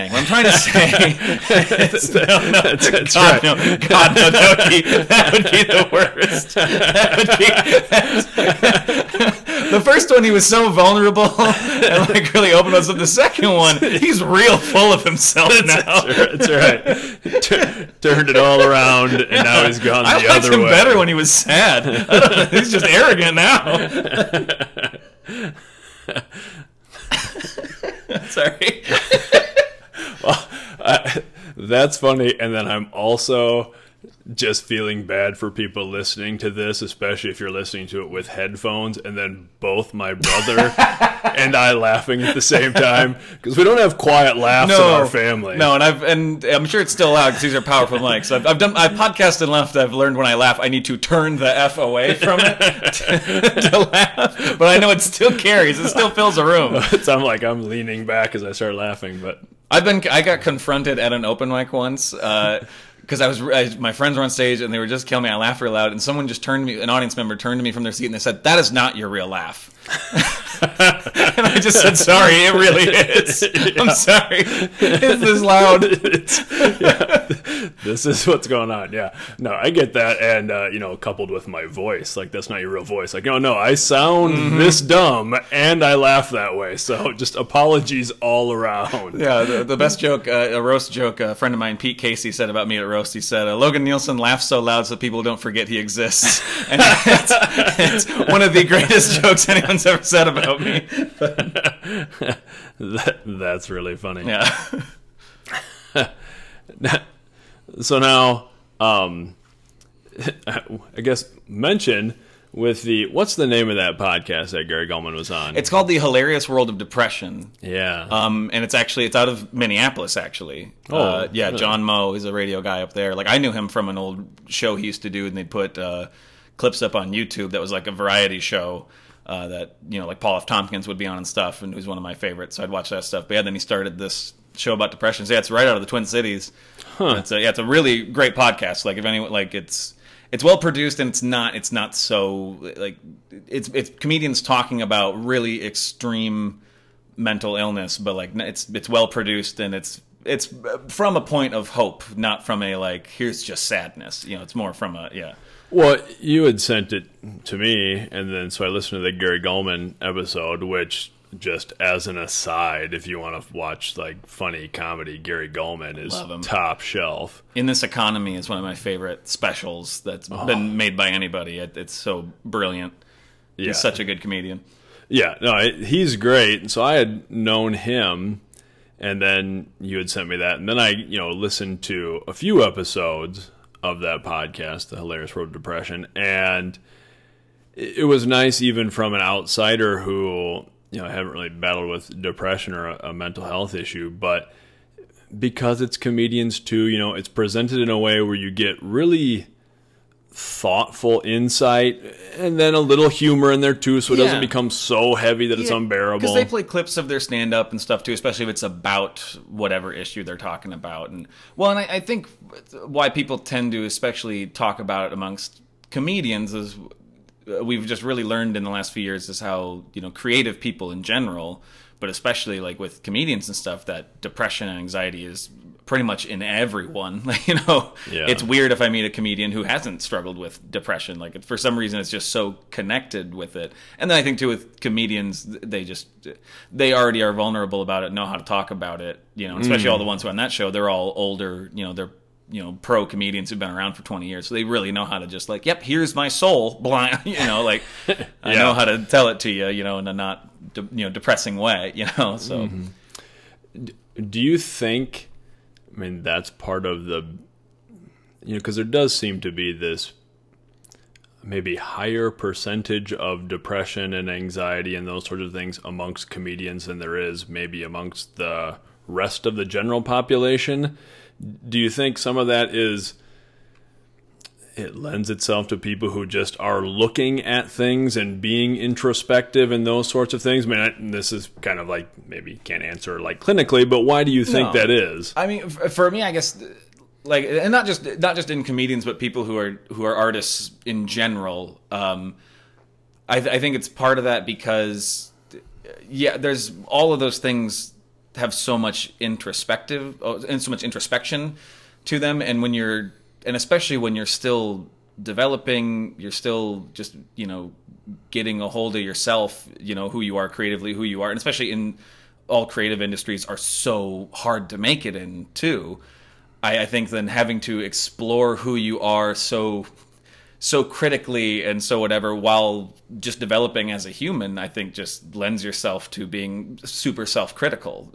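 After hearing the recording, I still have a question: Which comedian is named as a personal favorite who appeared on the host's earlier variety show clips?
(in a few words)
Paul F. Tompkins.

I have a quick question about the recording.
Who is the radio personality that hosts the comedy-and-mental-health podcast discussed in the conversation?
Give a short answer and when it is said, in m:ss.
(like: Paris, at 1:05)
John Moe, at 2:01.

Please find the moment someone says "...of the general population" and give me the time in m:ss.
4:29.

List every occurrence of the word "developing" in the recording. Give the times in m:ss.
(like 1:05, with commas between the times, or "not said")
5:05, 5:23.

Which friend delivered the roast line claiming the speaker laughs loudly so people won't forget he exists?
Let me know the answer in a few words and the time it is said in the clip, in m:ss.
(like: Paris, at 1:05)
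Pete Casey, at 1:31.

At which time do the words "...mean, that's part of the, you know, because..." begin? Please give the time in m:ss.
4:15.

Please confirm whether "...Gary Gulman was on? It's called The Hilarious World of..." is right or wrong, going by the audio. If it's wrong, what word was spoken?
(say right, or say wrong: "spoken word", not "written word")
right.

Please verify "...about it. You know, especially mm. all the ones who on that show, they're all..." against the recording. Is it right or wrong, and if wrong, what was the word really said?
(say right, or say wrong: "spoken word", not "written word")
right.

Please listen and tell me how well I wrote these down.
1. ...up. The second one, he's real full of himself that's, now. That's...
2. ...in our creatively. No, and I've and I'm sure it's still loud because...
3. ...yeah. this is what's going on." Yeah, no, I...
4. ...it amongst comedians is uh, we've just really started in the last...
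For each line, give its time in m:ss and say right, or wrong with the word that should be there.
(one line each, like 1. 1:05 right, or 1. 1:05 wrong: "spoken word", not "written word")
1. 0:12 right
2. 0:44 wrong: "family", not "creatively"
3. 1:16 right
4. 3:35 wrong: "learned", not "started".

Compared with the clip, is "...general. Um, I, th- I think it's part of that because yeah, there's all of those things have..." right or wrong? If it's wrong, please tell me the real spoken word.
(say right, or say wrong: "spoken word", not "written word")
right.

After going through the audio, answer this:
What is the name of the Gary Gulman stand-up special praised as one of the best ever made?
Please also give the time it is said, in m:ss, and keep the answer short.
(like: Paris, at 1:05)
In This Economy, at 2:47.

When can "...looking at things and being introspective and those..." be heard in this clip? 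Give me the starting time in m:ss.
4:36.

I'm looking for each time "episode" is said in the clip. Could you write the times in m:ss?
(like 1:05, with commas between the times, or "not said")
2:40, 3:02.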